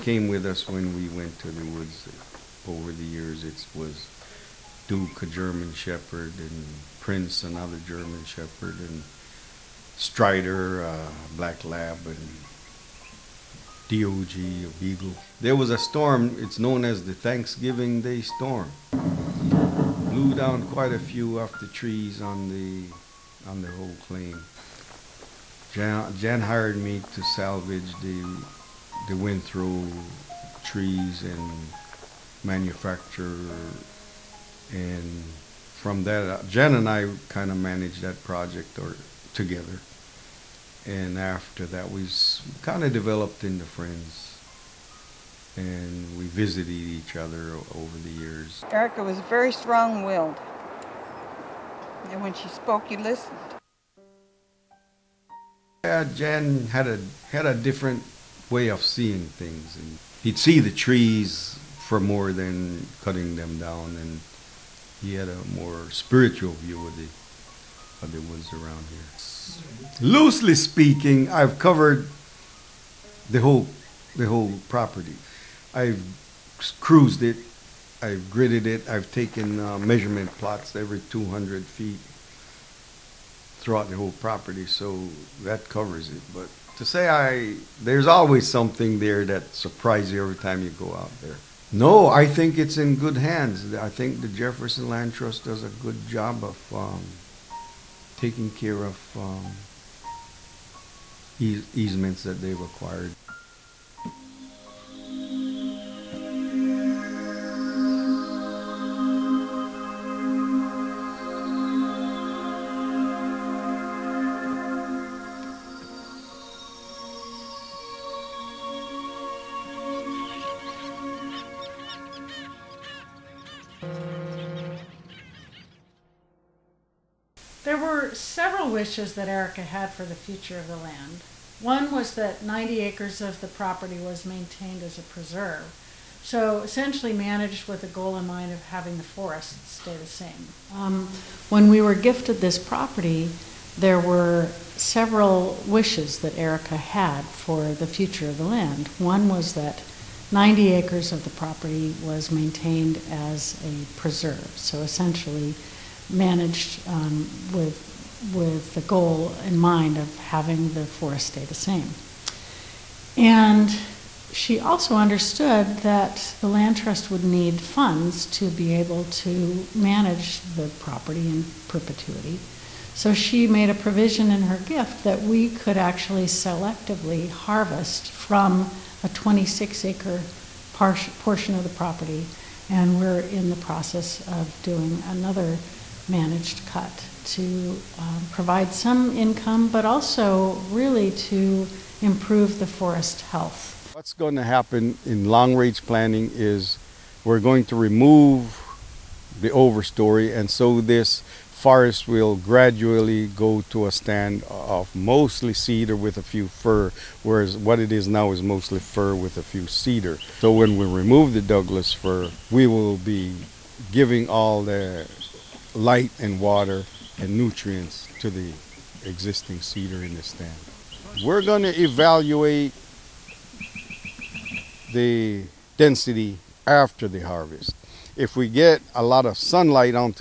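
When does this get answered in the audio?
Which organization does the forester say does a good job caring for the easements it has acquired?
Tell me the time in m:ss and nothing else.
1:34.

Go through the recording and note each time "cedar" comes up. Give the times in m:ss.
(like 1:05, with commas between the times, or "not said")
3:25, 3:29, 3:39.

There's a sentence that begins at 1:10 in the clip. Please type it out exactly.
Loosely speaking, I've covered the whole the whole property.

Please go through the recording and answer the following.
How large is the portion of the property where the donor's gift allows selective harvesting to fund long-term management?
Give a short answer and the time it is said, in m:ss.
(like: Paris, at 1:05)
26 acres, at 2:59.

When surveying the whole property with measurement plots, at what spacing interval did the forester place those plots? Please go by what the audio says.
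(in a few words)
200 feet.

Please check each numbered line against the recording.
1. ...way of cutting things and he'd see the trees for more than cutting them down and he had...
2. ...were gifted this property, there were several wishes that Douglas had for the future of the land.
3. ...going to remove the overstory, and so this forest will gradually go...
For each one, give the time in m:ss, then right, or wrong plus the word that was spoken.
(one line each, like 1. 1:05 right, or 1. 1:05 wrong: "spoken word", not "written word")
1. 0:58 wrong: "seeing", not "cutting"
2. 2:21 wrong: "Erika", not "Douglas"
3. 3:17 right.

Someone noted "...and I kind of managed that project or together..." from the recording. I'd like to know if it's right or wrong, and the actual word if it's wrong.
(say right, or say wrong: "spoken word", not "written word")
right.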